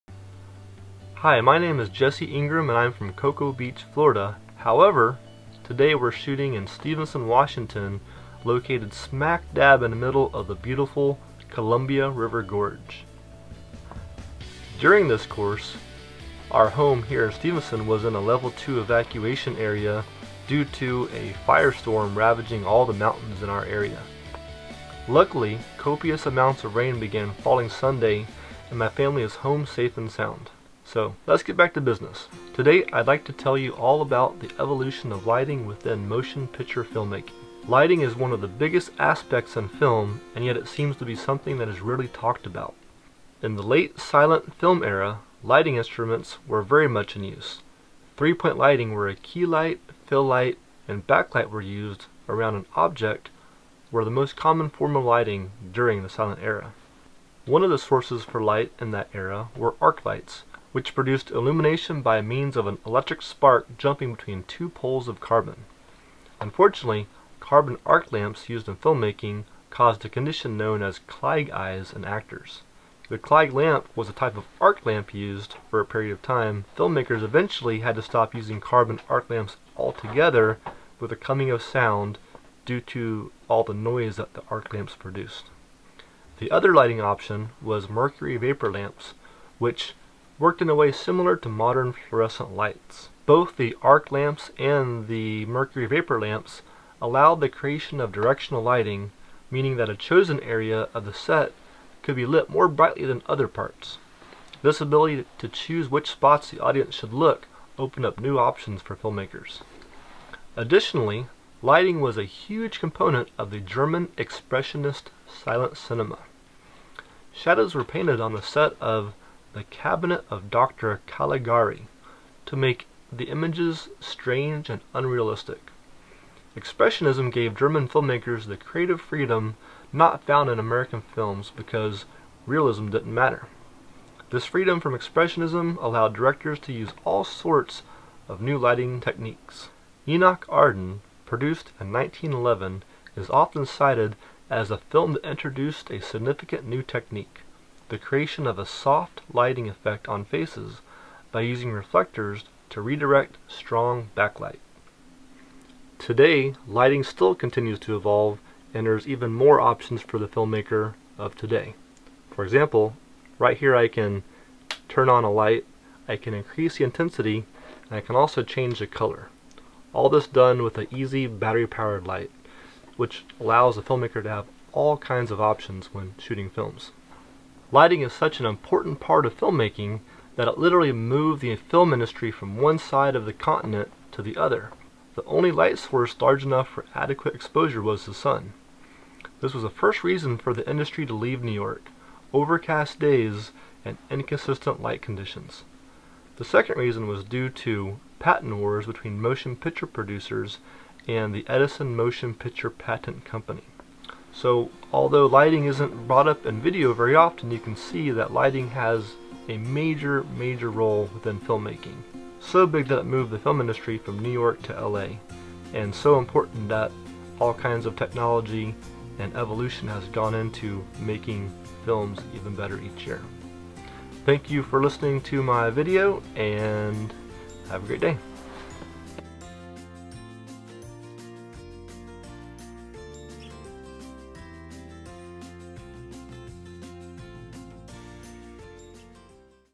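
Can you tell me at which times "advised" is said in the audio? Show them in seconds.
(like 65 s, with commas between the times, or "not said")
not said.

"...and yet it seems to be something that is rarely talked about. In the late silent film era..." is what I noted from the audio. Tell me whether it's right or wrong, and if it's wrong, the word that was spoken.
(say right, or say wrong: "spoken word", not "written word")
right.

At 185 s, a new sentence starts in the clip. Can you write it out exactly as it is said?
The only light source large enough for adequate exposure was the sun.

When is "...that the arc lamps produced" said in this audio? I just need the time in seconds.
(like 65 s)
84 s.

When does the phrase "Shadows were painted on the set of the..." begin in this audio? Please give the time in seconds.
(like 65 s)
117 s.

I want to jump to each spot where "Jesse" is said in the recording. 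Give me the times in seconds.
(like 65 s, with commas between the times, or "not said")
1 s.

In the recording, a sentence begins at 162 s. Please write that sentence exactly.
For example, right here I can turn on a light, I can increase the intensity, and I can also change the color.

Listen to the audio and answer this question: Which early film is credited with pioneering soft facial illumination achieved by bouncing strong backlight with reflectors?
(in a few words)
Enoch Arden.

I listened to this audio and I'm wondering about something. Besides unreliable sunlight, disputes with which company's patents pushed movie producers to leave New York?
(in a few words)
Edison Motion Picture Patent Company.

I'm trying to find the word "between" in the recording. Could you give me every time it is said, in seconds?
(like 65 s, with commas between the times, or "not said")
64 s, 198 s.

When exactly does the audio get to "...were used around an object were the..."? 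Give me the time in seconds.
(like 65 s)
51 s.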